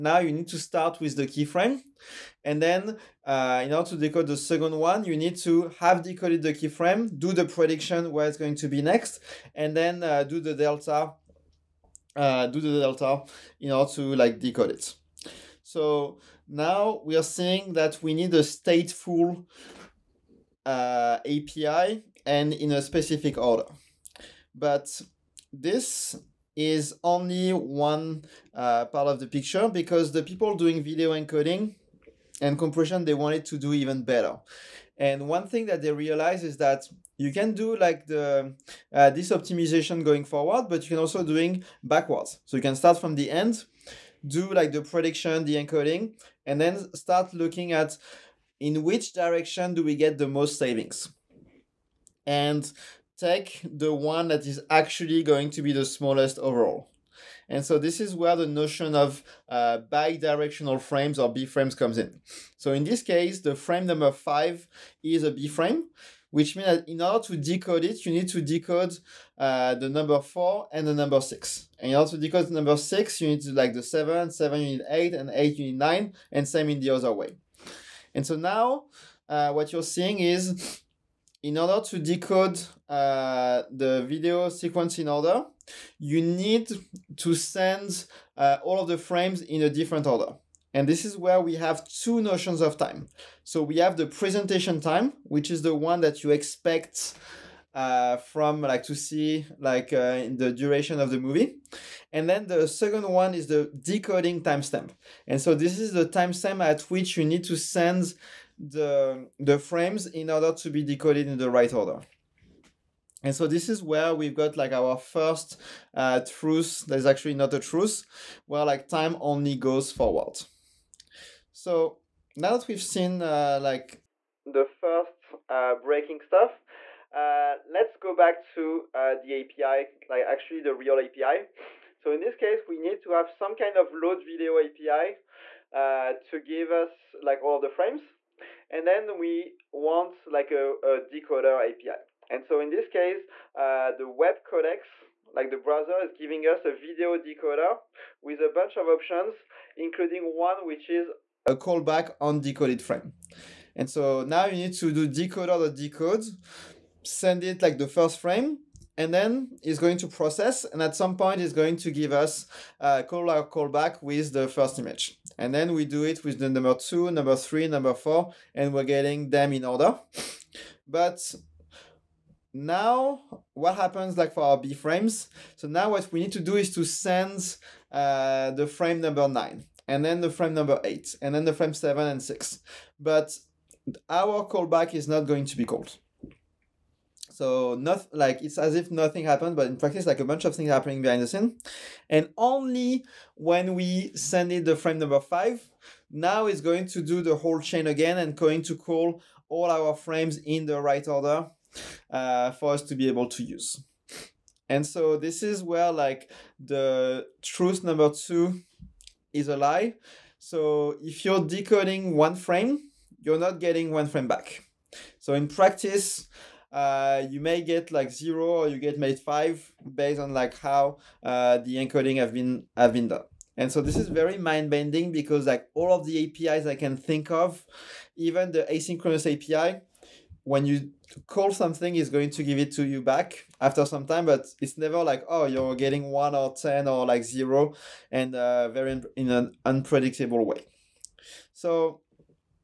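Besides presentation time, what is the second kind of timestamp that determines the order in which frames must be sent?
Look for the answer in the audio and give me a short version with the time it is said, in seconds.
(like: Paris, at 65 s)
Decoding timestamp, at 103 s.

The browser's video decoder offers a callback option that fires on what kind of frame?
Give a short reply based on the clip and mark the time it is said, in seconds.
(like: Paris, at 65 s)
Decoded frame, at 152 s.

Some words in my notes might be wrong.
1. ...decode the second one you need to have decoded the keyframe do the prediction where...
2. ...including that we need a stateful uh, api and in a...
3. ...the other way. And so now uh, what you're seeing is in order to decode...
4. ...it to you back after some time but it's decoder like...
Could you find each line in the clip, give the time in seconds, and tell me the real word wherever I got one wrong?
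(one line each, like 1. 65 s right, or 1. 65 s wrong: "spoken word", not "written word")
1. 3 s right
2. 17 s wrong: "seeing", not "including"
3. 76 s right
4. 232 s wrong: "never", not "decoder".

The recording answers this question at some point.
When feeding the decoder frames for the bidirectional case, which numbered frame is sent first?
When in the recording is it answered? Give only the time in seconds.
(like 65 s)
178 s.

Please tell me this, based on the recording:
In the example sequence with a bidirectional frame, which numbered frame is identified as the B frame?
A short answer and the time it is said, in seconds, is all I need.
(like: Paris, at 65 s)
5, at 63 s.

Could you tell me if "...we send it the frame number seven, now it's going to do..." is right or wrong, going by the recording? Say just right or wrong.
wrong.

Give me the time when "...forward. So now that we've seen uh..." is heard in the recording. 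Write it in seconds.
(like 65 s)
119 s.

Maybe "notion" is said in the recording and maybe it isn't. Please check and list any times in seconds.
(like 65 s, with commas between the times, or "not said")
58 s, 92 s.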